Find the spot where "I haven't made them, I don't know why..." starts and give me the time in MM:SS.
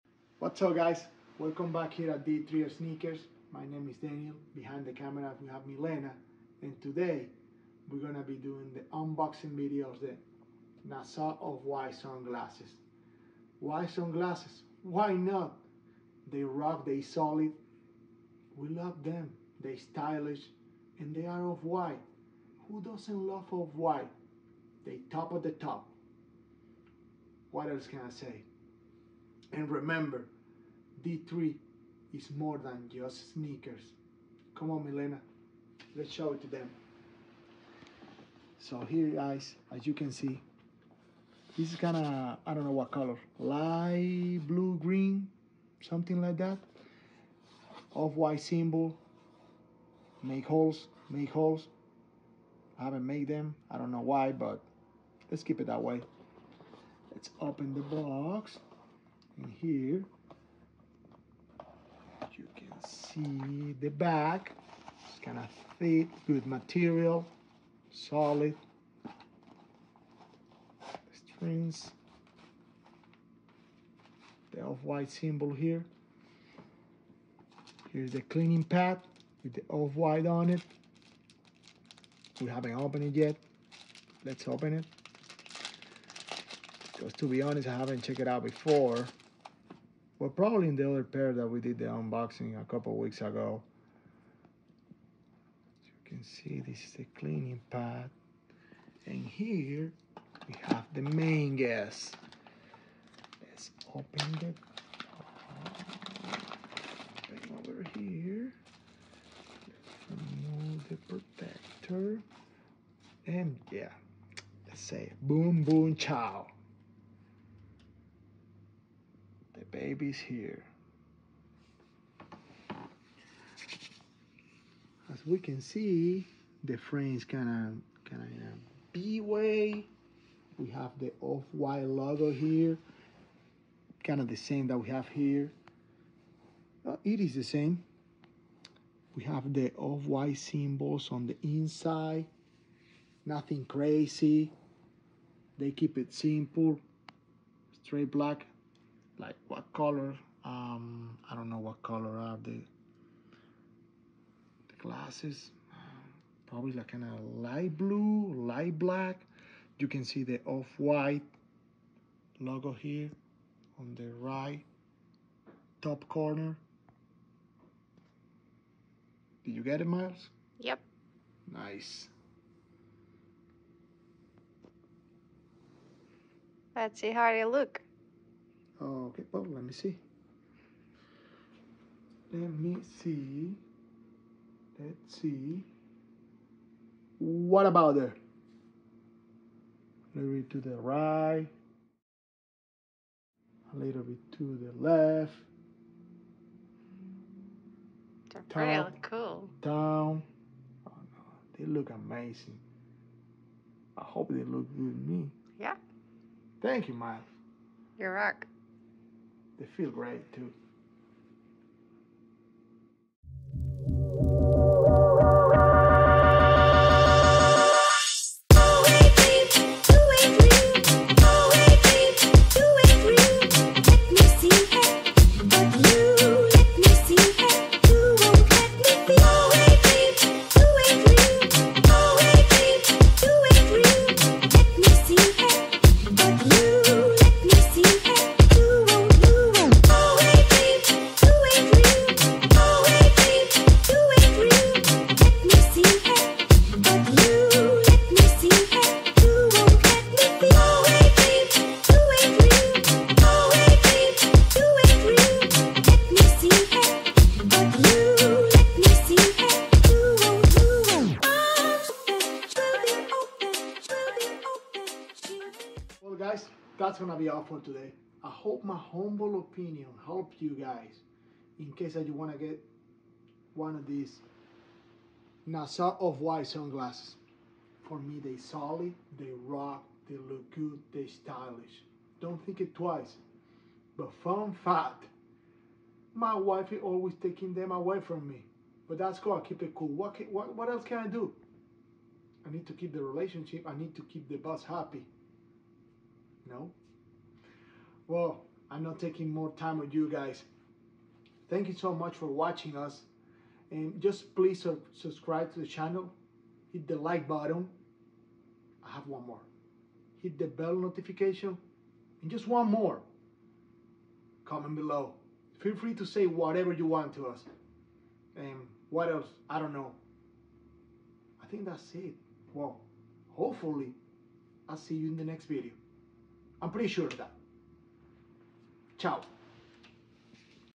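00:52.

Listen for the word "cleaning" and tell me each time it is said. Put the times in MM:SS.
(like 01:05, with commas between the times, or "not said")
01:18, 01:37.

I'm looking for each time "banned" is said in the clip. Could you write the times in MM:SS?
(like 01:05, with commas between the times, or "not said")
not said.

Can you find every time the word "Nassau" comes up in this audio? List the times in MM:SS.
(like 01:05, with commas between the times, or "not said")
00:10, 04:35.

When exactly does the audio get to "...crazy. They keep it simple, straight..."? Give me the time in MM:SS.
02:23.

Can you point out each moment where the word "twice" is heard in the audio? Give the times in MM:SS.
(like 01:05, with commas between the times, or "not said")
04:42.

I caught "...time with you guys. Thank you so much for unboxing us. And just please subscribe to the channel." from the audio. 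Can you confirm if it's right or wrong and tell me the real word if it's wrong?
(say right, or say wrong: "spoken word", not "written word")
wrong: "watching", not "unboxing".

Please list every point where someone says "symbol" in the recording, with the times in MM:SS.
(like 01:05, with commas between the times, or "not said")
00:48, 01:15, 02:20.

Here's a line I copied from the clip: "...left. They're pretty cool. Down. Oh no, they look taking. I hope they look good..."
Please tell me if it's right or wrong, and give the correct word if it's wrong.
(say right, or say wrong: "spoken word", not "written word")
wrong: "amazing", not "taking".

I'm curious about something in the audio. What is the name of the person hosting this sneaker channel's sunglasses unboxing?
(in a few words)
Daniel.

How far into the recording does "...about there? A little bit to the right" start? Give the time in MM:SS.
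03:07.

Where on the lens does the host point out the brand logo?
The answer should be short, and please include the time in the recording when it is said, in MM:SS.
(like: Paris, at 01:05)
Right top corner, at 02:44.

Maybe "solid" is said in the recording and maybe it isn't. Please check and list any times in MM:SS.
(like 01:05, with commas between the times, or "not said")
00:17, 01:07, 04:38.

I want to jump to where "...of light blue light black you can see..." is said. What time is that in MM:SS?
02:37.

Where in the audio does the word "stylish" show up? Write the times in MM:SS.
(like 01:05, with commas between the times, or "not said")
00:19, 04:41.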